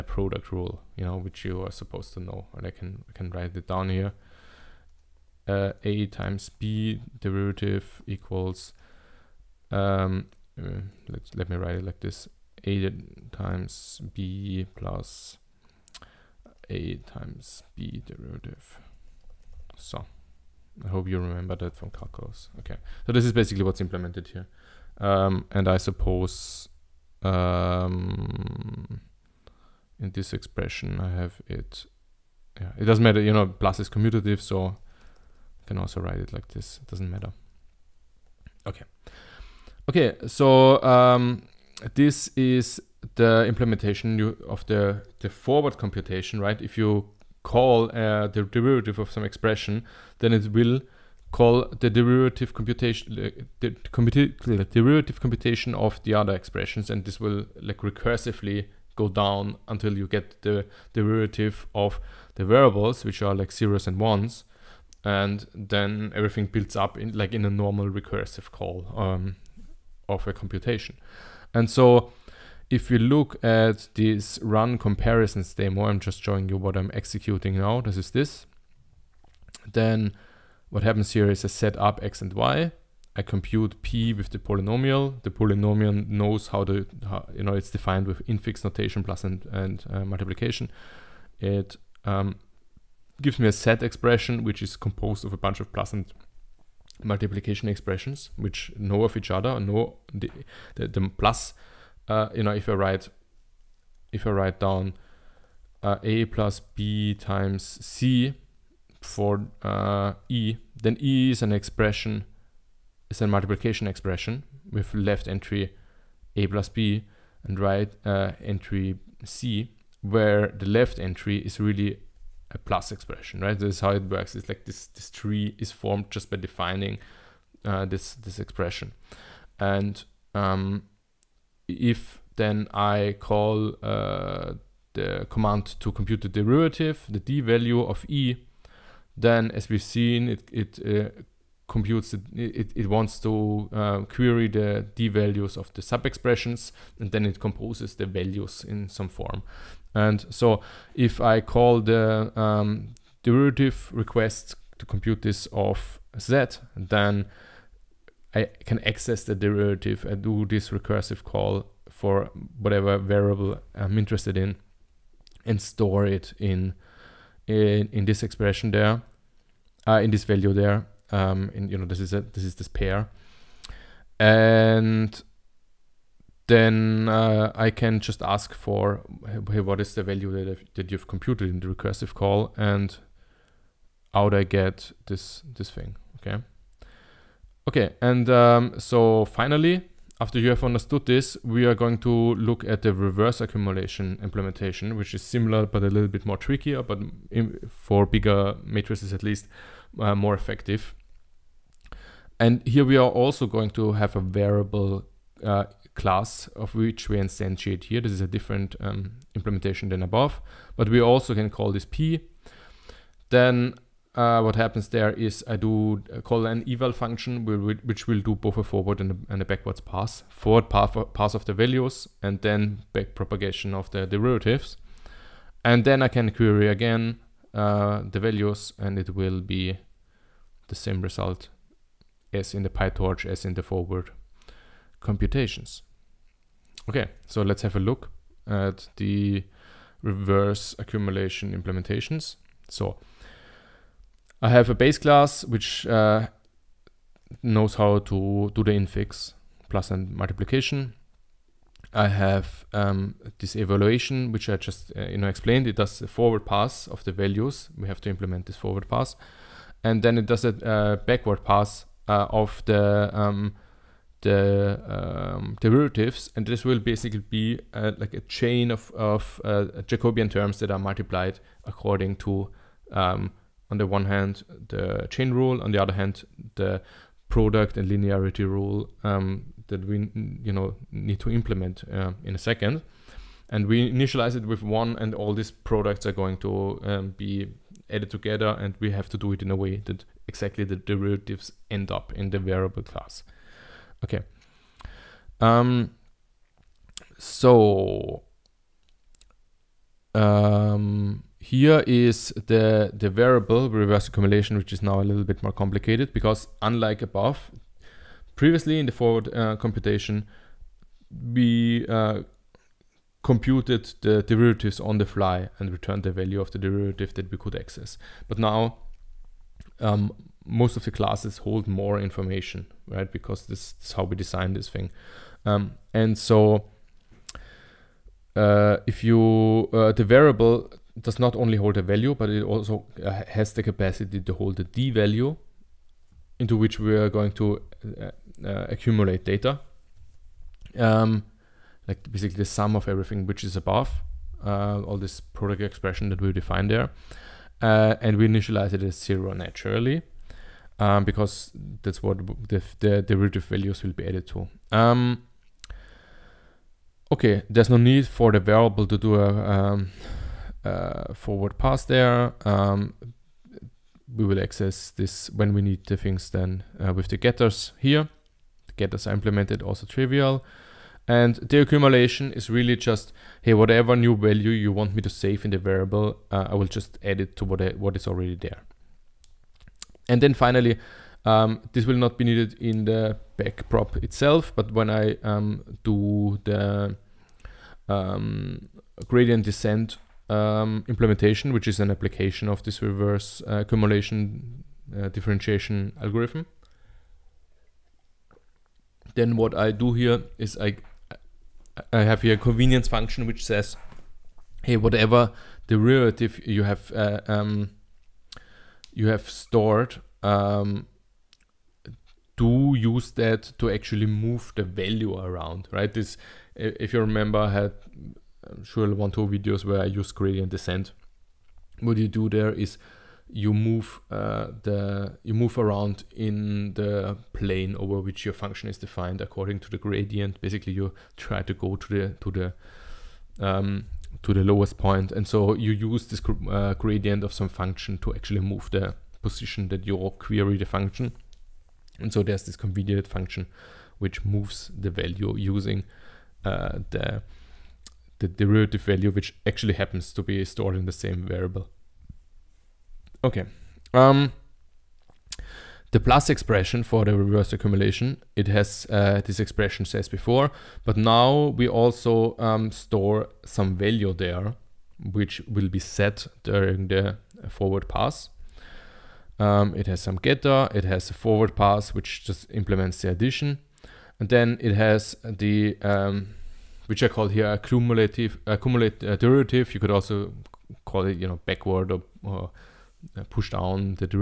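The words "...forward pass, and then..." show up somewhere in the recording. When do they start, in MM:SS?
04:18.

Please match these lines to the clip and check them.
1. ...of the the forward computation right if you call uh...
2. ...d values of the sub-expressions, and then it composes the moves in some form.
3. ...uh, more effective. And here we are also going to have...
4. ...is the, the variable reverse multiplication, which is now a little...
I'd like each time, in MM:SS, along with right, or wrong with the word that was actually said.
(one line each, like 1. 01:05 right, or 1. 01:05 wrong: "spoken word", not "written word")
1. 00:44 right
2. 02:24 wrong: "values", not "moves"
3. 03:19 right
4. 05:01 wrong: "accumulation", not "multiplication".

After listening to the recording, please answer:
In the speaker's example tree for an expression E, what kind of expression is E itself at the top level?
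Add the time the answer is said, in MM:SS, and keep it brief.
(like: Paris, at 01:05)
multiplication expression, at 01:53.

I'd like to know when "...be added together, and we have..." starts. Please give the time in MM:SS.
04:47.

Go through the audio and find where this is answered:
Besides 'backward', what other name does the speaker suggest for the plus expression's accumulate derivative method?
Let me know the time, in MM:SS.
08:03.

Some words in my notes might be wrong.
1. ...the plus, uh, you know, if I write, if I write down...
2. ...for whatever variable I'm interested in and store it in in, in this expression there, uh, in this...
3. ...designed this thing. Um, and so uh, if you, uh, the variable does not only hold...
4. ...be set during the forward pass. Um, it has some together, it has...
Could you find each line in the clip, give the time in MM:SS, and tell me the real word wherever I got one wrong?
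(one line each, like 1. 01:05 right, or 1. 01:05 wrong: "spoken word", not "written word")
1. 01:40 right
2. 02:41 right
3. 05:24 right
4. 07:45 wrong: "getter", not "together".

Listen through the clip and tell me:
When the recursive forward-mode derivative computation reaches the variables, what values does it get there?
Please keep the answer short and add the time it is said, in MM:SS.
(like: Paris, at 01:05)
zeros and ones, at 01:03.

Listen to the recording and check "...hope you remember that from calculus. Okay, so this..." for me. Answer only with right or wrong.
right.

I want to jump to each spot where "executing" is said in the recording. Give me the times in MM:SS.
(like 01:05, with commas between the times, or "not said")
01:16.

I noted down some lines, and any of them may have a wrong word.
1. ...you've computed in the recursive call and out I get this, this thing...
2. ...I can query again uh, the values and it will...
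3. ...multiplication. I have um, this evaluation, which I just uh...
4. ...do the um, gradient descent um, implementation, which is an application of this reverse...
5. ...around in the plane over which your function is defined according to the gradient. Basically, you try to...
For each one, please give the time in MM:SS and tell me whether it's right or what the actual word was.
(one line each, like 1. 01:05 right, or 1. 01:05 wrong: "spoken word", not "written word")
1. 03:00 right
2. 03:46 right
3. 04:10 right
4. 06:25 right
5. 07:05 right.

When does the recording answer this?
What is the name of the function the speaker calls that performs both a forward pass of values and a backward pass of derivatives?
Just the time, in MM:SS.
03:36.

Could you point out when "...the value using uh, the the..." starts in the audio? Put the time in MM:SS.
07:24.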